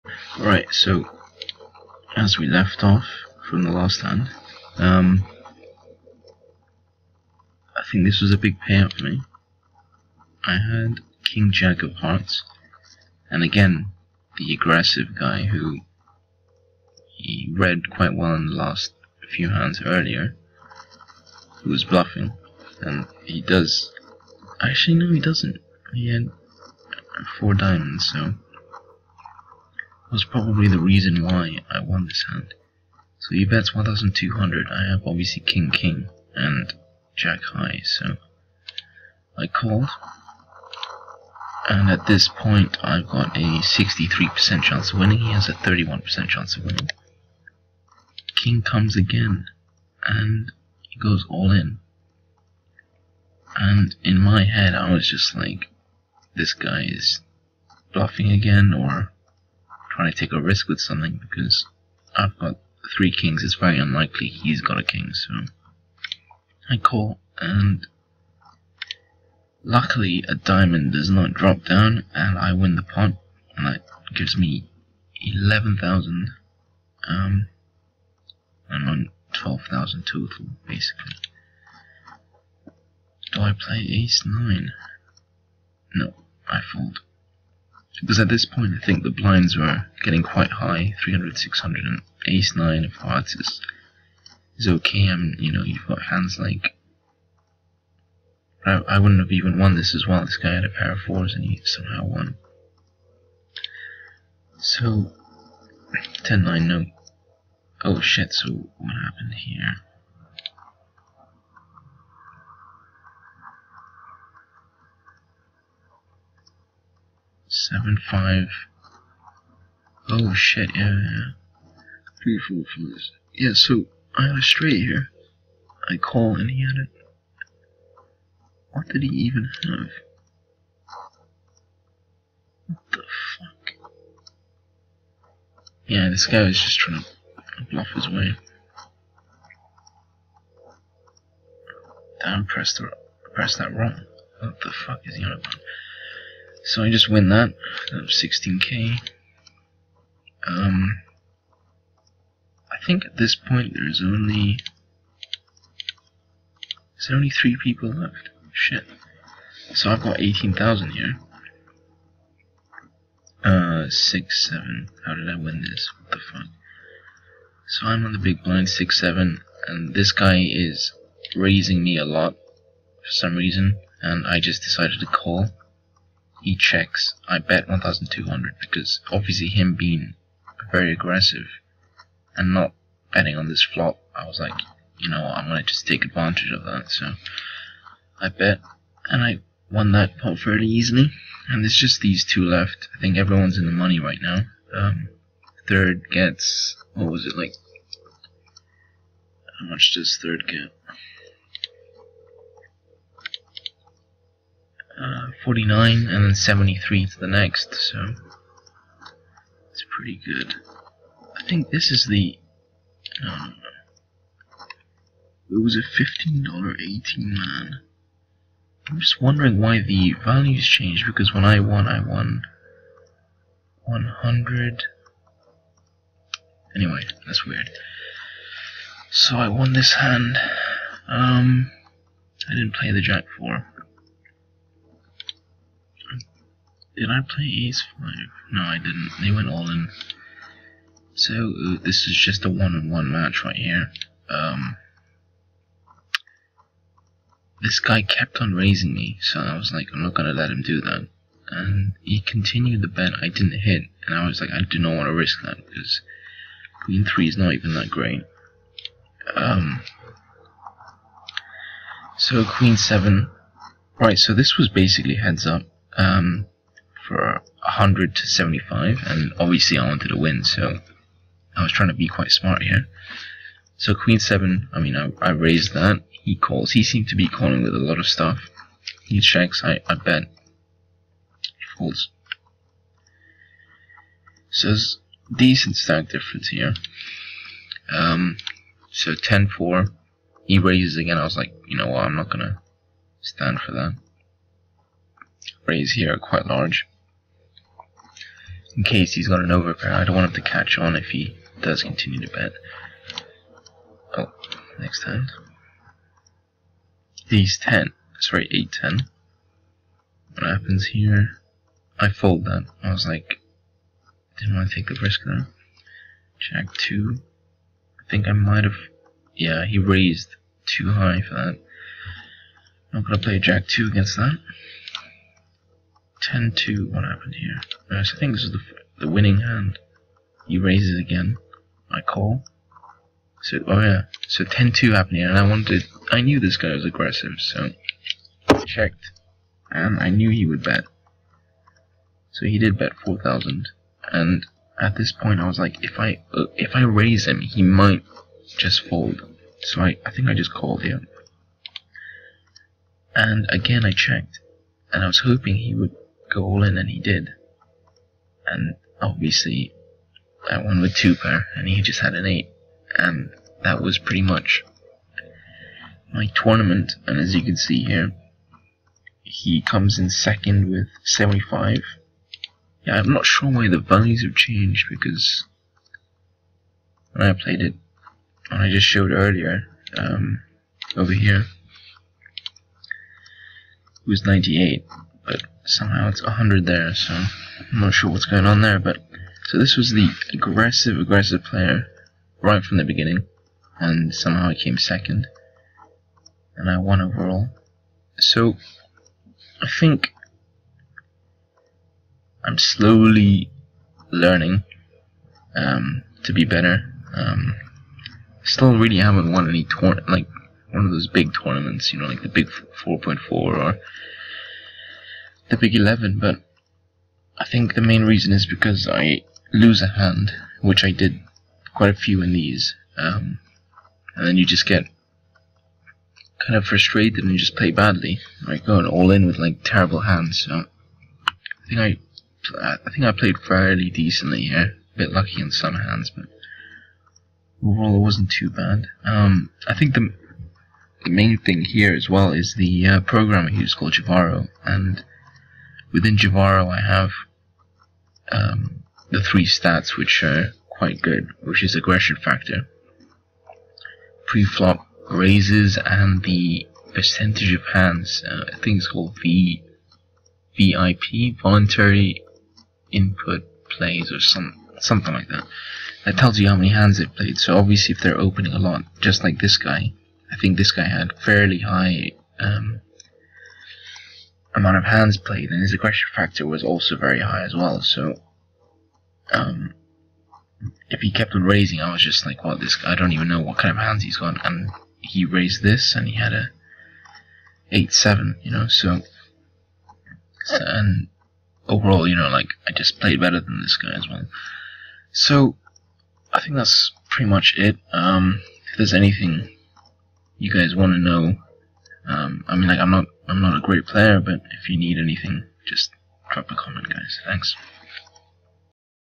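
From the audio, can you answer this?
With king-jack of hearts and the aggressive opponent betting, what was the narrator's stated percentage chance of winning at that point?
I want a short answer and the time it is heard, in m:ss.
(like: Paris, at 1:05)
63%, at 0:43.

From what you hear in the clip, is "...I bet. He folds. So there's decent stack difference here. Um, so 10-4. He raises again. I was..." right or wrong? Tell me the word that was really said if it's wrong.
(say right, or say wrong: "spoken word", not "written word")
right.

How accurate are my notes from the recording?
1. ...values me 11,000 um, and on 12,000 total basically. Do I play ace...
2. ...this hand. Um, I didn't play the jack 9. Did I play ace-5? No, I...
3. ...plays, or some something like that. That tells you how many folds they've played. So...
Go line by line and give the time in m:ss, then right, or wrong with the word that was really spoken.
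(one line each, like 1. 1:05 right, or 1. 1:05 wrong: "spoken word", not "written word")
1. 1:14 wrong: "gives", not "values"
2. 3:49 wrong: "4", not "9"
3. 7:43 wrong: "hands", not "folds".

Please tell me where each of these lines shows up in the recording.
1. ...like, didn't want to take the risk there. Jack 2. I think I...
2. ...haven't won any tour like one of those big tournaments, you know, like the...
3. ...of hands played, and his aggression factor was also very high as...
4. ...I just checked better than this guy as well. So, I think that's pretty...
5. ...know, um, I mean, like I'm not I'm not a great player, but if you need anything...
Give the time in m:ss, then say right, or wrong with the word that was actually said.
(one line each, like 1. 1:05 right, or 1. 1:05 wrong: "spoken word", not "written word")
1. 5:13 right
2. 6:48 right
3. 7:54 right
4. 8:12 wrong: "played", not "checked"
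5. 8:20 right.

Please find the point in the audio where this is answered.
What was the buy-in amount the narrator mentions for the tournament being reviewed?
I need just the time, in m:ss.
3:36.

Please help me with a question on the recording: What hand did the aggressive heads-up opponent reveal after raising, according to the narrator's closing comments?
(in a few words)
Eight seven.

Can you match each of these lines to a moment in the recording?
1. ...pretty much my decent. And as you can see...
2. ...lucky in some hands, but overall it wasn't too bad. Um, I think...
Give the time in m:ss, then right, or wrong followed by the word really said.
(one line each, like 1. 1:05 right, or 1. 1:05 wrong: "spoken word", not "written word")
1. 6:03 wrong: "tournament", not "decent"
2. 7:15 right.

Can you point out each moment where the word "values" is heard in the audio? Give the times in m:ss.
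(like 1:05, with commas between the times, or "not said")
3:40, 6:13.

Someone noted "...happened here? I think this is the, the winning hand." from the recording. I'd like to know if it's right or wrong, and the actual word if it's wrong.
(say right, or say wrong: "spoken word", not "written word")
right.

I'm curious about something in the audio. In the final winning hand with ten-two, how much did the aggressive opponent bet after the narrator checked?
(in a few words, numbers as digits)
4,000.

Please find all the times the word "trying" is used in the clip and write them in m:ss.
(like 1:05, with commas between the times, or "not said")
0:59, 2:16, 4:31.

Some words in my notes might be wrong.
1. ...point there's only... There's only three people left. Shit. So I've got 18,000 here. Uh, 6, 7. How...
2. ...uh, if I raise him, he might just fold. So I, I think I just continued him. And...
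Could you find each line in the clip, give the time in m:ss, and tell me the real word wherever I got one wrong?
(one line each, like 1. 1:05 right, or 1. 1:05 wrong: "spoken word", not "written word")
1. 2:33 right
2. 5:46 wrong: "called", not "continued".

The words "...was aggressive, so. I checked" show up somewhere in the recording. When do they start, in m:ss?
5:36.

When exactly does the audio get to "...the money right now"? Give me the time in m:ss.
3:13.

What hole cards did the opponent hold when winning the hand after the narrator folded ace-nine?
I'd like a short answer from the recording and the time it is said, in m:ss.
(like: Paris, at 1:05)
A pair of 4s, at 1:40.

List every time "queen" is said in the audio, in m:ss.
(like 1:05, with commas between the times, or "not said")
4:16, 4:22, 4:33.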